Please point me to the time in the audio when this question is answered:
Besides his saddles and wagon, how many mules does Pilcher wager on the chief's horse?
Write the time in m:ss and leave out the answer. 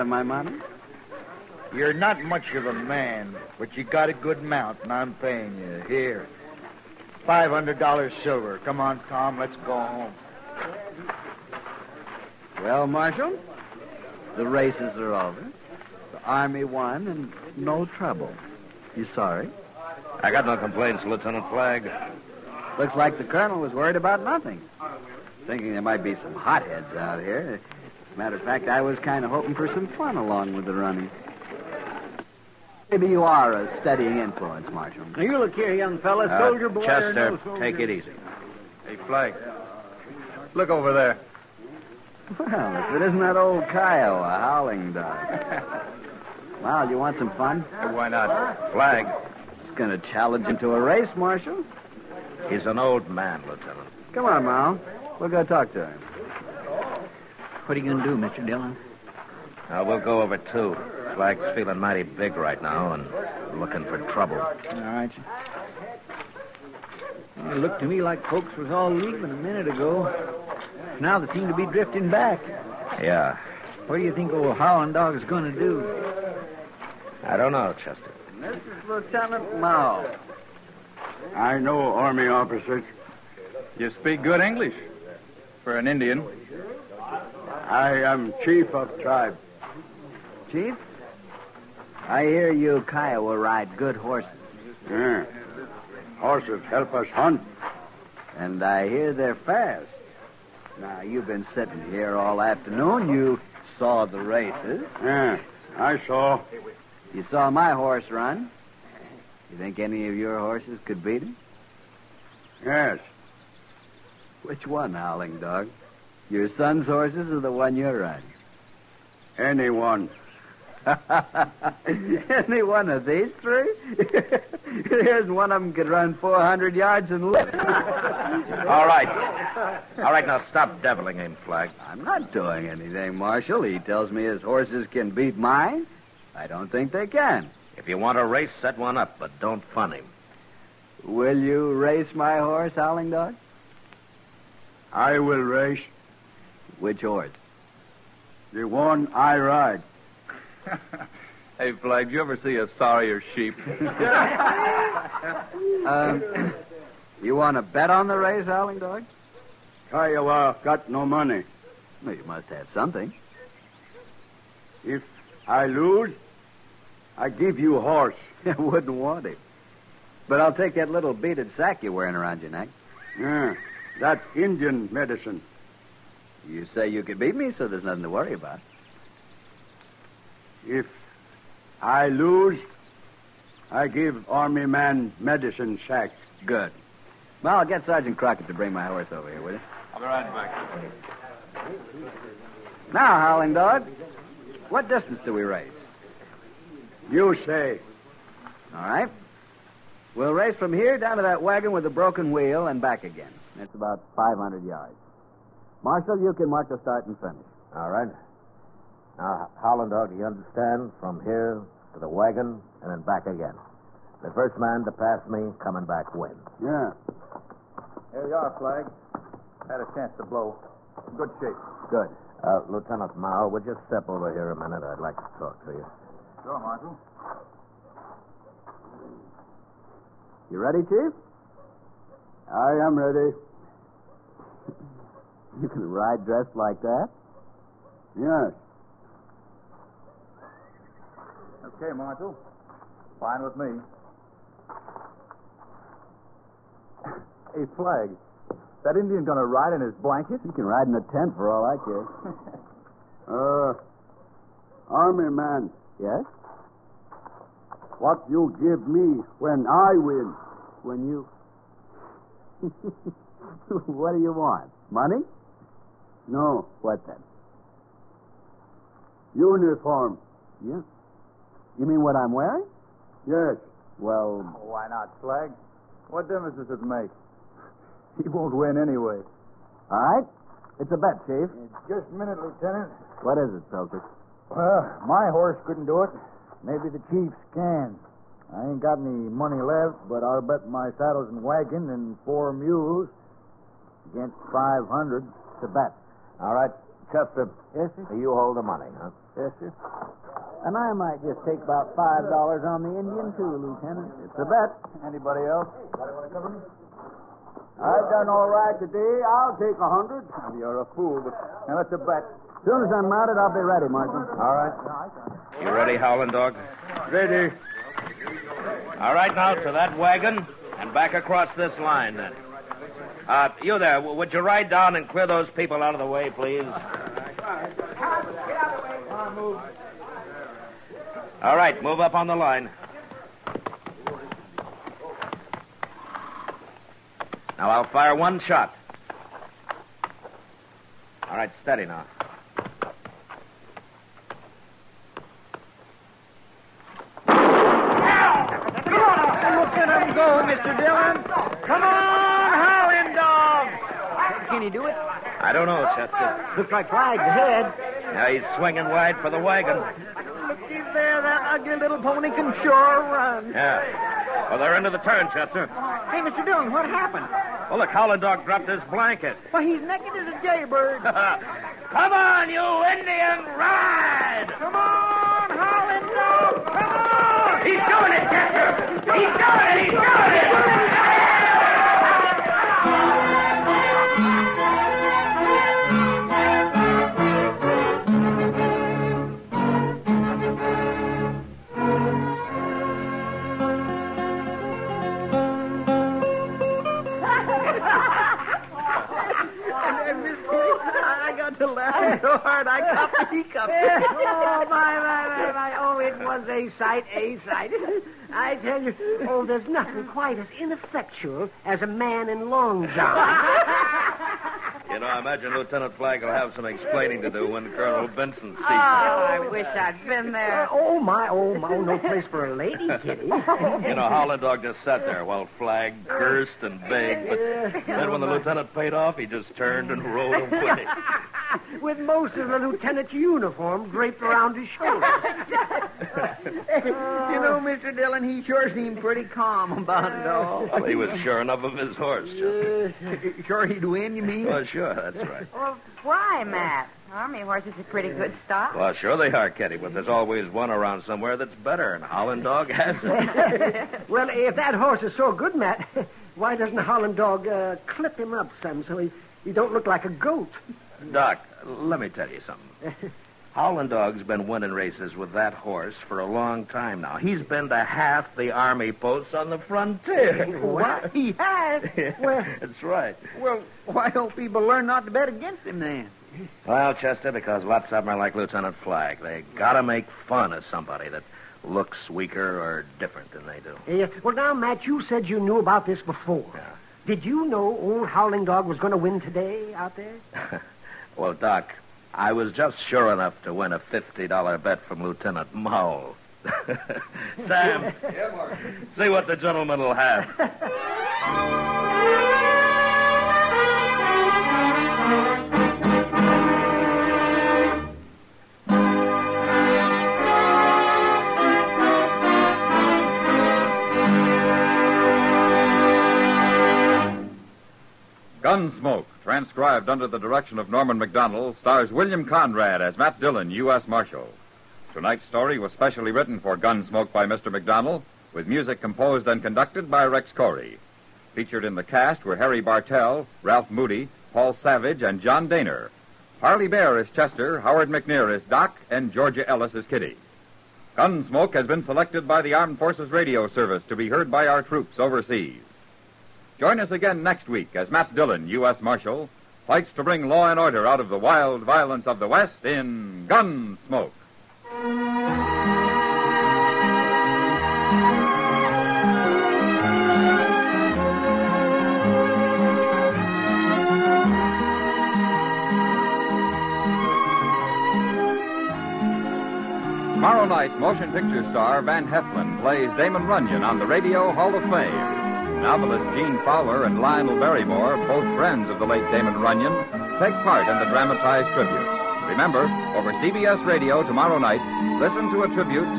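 4:52.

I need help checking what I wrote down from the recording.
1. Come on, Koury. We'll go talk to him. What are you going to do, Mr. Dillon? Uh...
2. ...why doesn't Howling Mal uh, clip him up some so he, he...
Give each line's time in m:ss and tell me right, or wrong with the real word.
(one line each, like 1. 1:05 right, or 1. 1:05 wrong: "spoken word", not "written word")
1. 0:54 wrong: "Mal", not "Koury"
2. 7:36 wrong: "Dog", not "Mal".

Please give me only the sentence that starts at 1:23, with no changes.
You speak good English for an Indian.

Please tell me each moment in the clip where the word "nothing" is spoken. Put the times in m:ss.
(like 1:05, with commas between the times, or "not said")
0:24, 2:57, 6:49.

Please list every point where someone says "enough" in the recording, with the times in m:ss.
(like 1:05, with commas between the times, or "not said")
7:21, 8:13.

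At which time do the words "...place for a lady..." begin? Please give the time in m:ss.
7:01.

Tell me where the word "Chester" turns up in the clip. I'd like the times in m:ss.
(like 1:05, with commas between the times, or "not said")
0:36, 1:17, 4:57, 5:55, 6:05, 6:18, 7:56, 8:57.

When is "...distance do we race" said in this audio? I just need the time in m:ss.
3:14.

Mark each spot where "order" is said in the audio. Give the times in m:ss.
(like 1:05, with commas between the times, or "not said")
9:10.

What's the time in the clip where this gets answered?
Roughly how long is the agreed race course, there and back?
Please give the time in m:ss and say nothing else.
3:24.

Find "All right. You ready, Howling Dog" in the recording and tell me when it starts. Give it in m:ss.
5:14.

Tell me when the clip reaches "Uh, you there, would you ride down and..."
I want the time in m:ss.
5:23.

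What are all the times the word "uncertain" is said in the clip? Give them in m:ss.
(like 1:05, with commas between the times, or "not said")
not said.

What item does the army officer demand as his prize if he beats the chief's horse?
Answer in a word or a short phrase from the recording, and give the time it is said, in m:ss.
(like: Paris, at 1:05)
beaded sack, at 2:50.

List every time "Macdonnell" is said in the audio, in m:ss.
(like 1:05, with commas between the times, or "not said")
8:40, 8:47.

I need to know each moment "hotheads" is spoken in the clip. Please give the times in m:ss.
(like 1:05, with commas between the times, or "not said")
0:26.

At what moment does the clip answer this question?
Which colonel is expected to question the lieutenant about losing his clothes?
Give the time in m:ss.
6:57.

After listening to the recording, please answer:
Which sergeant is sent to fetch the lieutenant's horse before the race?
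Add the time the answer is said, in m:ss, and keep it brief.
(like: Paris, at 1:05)
Crockett, at 3:07.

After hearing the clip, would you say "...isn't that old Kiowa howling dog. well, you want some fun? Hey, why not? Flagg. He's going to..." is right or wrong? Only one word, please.
right.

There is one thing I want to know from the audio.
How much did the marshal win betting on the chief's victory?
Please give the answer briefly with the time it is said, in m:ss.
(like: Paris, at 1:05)
$50, at 8:13.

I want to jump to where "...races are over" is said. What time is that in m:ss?
0:14.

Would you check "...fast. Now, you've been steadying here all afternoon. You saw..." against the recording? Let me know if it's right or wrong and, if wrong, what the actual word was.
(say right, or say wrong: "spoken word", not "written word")
wrong: "sitting", not "steadying".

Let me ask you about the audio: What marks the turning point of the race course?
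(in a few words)
wagon with the broken wheel.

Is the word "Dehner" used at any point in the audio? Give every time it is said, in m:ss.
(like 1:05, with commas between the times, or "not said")
8:55.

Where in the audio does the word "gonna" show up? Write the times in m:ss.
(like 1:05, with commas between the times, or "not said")
4:09.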